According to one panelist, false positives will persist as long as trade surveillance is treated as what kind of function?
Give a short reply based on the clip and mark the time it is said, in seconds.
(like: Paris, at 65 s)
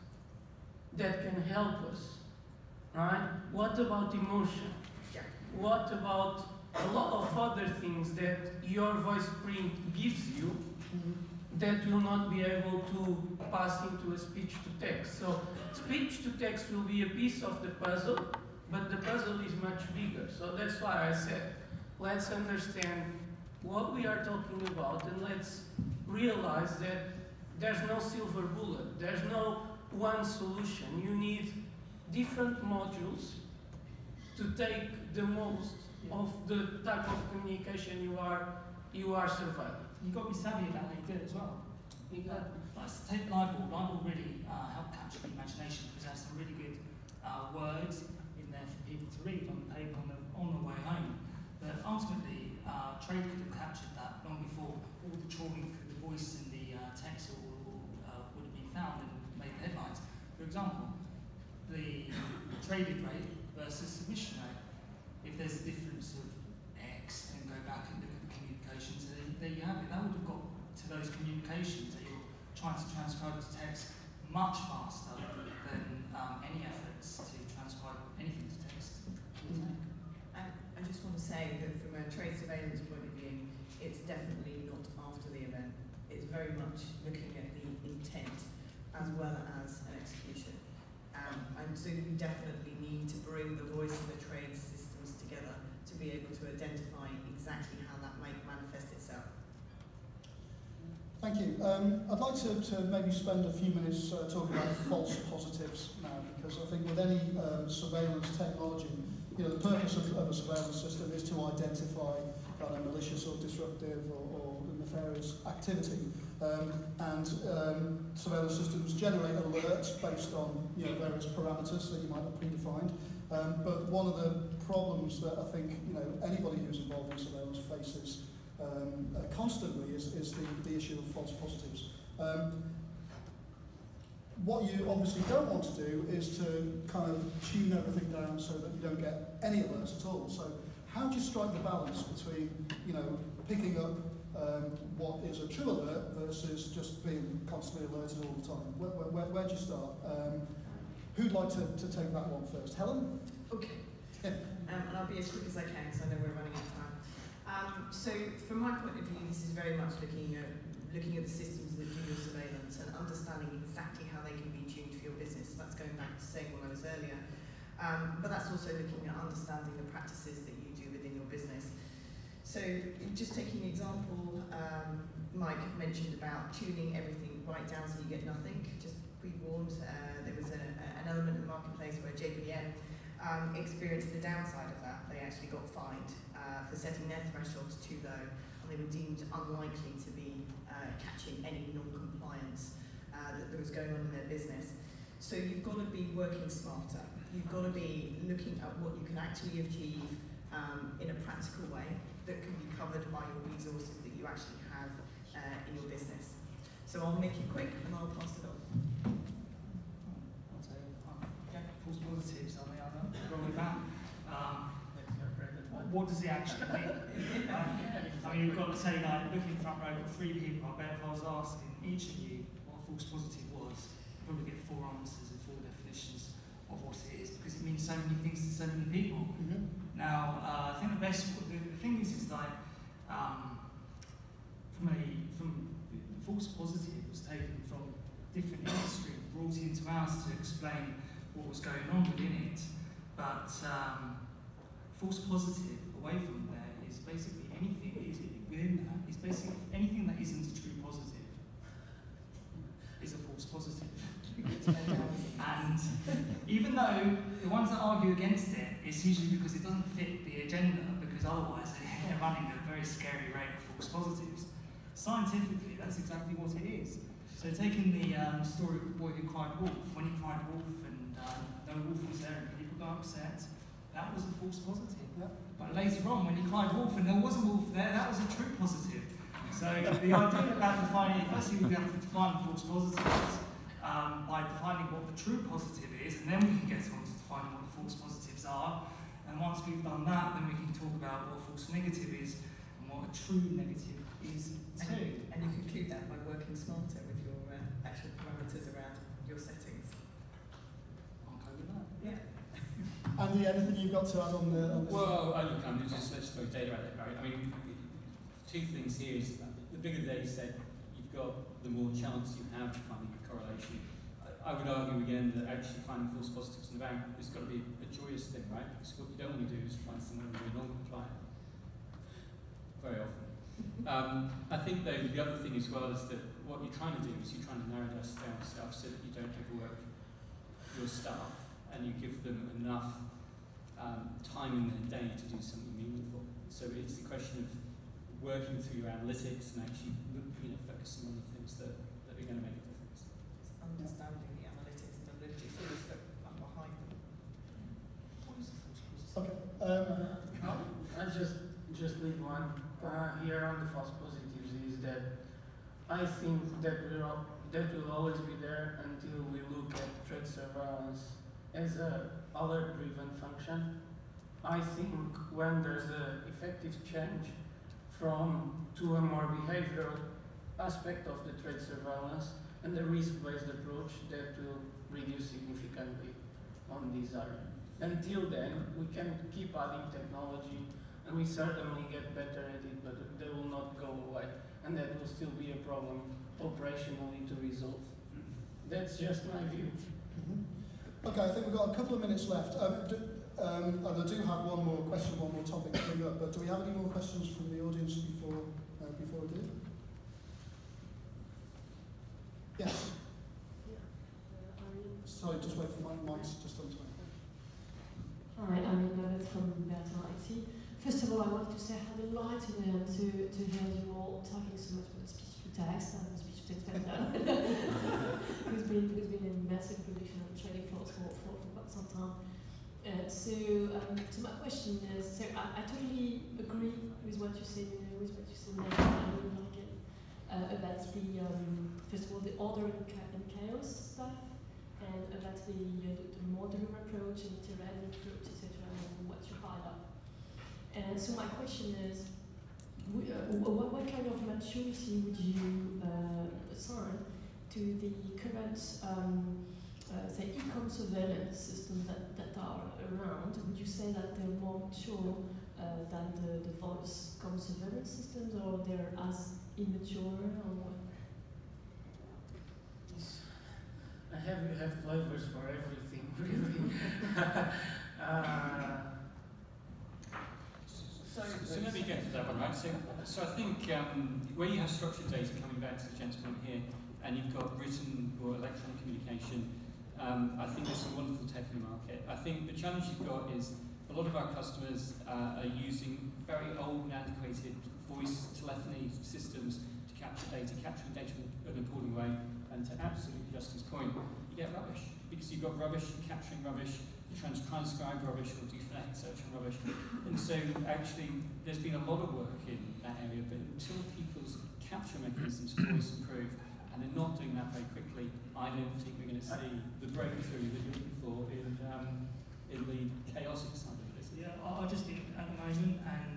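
alert-driven, at 362 s.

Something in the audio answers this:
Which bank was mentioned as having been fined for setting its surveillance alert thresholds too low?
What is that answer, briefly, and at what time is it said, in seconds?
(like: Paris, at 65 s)
JPM, at 182 s.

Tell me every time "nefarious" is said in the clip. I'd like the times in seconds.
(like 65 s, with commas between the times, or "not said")
114 s.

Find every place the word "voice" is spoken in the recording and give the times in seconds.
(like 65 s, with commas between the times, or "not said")
8 s, 56 s, 93 s, 456 s, 487 s.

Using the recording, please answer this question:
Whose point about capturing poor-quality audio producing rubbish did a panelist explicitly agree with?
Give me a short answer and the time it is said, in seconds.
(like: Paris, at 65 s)
Justin, at 493 s.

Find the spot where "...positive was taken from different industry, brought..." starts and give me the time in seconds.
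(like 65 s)
236 s.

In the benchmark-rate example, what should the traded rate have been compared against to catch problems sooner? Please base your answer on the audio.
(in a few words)
submission rate.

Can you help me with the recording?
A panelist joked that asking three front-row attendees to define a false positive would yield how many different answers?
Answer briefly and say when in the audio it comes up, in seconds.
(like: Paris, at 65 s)
4, at 224 s.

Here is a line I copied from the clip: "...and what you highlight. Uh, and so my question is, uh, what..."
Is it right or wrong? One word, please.
right.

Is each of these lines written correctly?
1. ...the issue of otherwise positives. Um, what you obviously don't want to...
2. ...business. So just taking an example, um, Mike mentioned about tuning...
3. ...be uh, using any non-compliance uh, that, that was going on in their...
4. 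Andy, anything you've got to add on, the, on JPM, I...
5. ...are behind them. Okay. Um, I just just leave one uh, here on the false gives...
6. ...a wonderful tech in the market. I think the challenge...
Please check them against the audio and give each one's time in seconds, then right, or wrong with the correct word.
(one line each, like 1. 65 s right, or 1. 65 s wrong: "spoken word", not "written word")
1. 130 s wrong: "false", not "otherwise"
2. 171 s right
3. 190 s wrong: "catching", not "using"
4. 303 s wrong: "Well", not "JPM"
5. 346 s wrong: "positives", not "gives"
6. 480 s right.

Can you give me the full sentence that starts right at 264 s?
Scientifically, that's exactly what it is.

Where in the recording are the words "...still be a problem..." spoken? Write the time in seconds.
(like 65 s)
385 s.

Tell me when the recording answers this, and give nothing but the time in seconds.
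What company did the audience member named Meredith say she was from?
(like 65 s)
409 s.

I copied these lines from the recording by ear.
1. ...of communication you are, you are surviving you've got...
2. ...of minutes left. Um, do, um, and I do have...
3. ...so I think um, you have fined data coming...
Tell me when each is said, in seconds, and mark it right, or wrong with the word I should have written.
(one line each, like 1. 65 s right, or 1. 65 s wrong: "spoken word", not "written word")
1. 37 s right
2. 391 s right
3. 473 s wrong: "structured", not "fined".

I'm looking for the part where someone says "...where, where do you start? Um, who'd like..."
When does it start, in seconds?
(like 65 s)
148 s.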